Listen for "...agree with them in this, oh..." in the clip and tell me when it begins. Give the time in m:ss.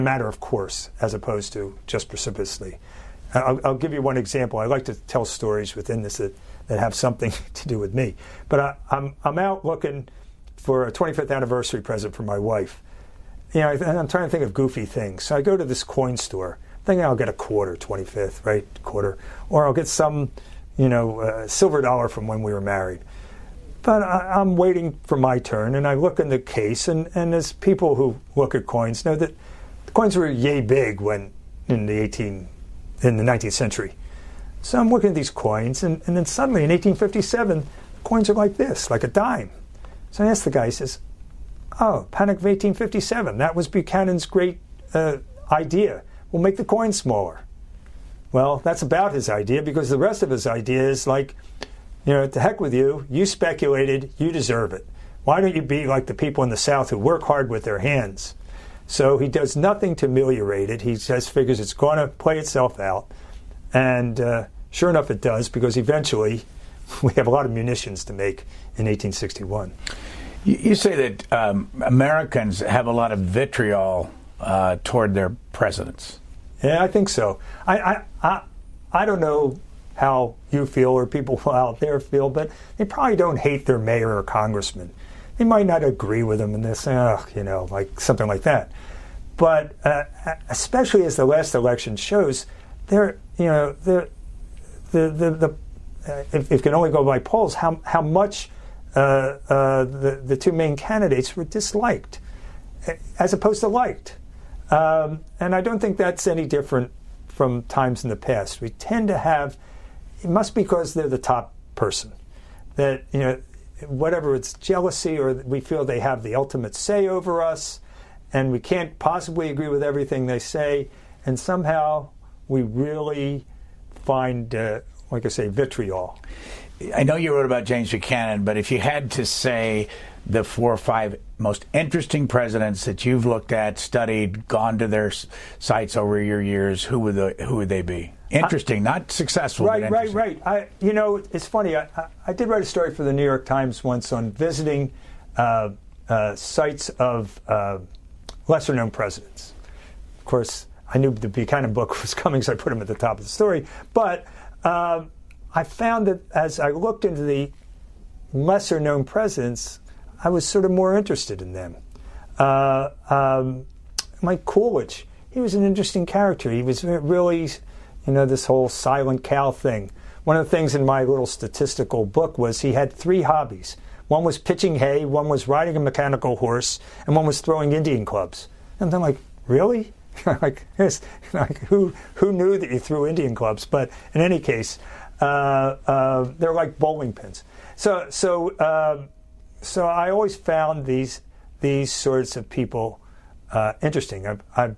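1:25.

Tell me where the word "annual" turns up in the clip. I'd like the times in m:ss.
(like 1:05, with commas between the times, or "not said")
not said.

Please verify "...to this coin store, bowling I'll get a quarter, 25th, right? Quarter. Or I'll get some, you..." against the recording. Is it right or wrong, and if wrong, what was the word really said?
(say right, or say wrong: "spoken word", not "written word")
wrong: "thinking", not "bowling".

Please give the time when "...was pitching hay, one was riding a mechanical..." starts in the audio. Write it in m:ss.
2:54.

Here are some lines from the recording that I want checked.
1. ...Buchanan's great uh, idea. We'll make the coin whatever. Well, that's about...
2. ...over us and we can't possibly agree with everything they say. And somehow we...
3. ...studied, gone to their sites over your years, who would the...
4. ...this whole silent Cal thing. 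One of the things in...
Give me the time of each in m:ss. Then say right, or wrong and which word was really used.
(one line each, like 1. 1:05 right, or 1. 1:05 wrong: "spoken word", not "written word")
1. 0:43 wrong: "smaller", not "whatever"
2. 1:57 right
3. 2:13 right
4. 2:48 right.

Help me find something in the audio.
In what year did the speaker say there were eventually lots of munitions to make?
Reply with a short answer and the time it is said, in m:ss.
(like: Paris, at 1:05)
1861, at 1:08.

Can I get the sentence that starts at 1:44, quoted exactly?
Um, and I don't think that's any different from times in the past.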